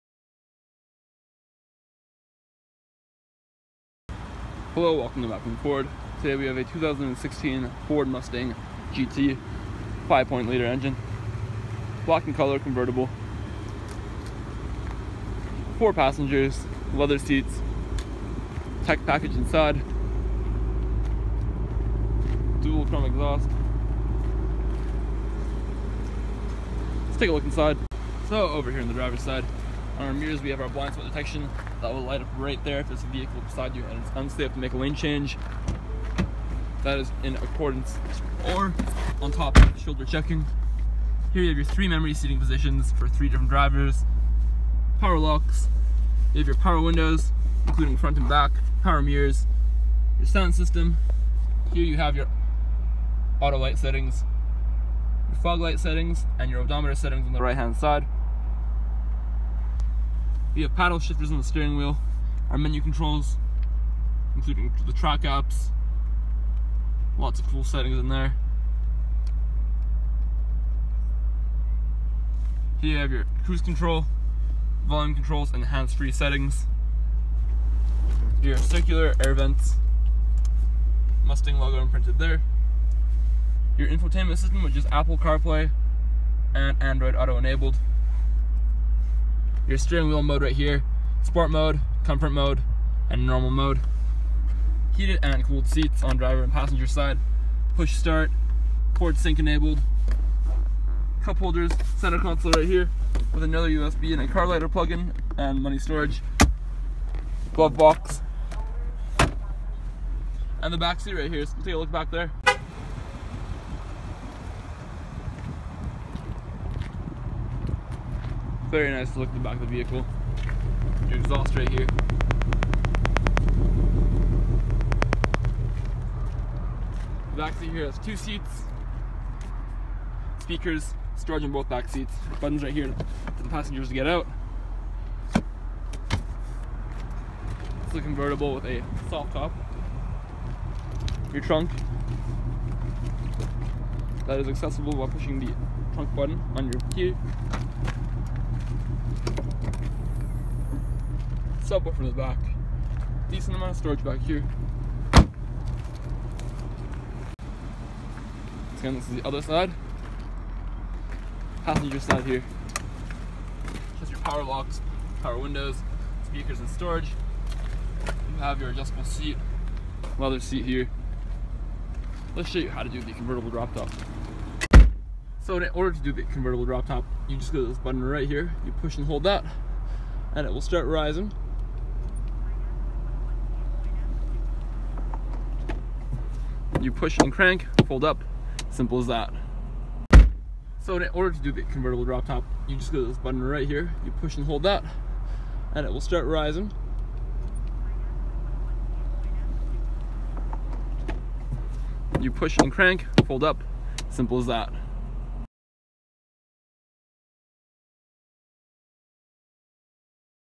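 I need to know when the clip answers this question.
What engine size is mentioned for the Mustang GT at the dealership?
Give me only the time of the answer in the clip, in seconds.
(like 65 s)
10 s.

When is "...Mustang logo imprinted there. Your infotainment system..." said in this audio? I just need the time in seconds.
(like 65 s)
81 s.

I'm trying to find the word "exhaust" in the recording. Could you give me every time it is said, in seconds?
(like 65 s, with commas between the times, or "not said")
23 s, 121 s.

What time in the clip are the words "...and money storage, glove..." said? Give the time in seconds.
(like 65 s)
105 s.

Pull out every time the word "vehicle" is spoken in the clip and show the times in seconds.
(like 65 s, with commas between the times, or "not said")
33 s, 119 s.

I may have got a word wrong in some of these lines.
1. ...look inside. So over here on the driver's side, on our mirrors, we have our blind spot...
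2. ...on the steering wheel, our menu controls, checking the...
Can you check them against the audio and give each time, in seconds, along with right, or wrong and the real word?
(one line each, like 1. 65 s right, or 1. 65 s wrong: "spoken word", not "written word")
1. 27 s right
2. 61 s wrong: "including", not "checking".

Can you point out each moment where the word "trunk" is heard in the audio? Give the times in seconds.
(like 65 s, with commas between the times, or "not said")
141 s, 145 s.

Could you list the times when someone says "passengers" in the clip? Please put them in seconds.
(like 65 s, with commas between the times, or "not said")
15 s, 96 s, 133 s, 161 s.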